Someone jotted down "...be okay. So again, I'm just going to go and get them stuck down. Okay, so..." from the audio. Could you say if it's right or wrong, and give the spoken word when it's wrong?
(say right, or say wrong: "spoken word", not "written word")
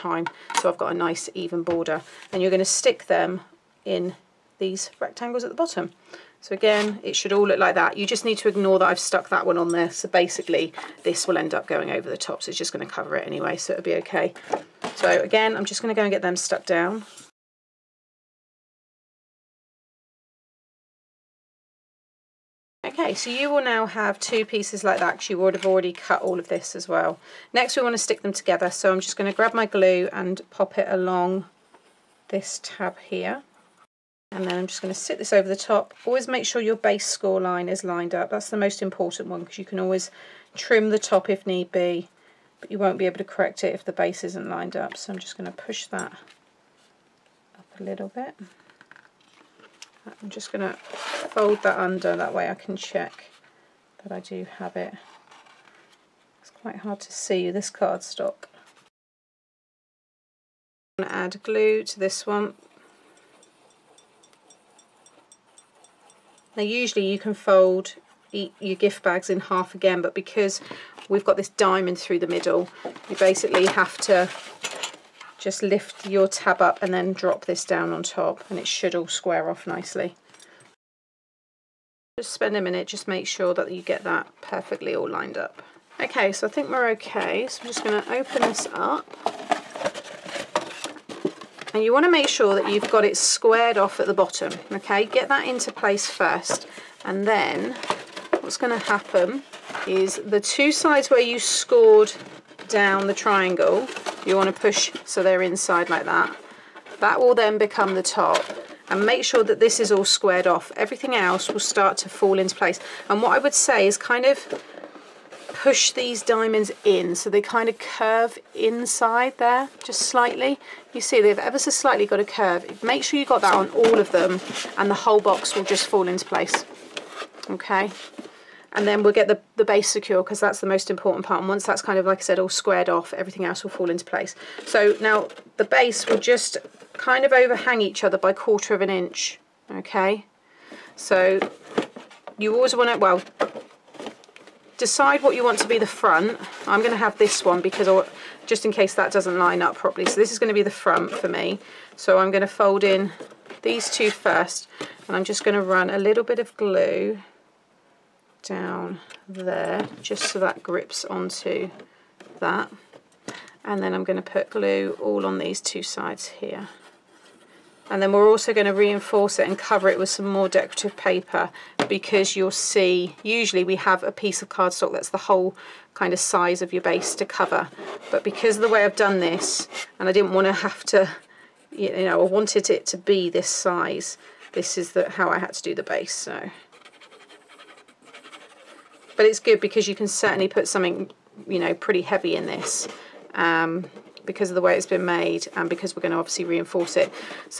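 right.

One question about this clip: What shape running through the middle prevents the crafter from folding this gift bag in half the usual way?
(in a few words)
diamond.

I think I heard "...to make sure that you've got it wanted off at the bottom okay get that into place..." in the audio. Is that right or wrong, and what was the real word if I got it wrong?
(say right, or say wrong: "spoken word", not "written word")
wrong: "squared", not "wanted".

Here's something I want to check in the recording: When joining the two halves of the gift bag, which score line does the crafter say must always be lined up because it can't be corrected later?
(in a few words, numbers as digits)
base score line.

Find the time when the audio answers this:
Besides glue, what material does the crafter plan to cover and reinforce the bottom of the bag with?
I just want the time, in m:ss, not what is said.
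2:50.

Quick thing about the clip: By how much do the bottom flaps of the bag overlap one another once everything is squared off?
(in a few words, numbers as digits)
quarter of an inch.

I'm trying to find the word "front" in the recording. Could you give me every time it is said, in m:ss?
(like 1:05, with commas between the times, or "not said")
2:26, 2:30.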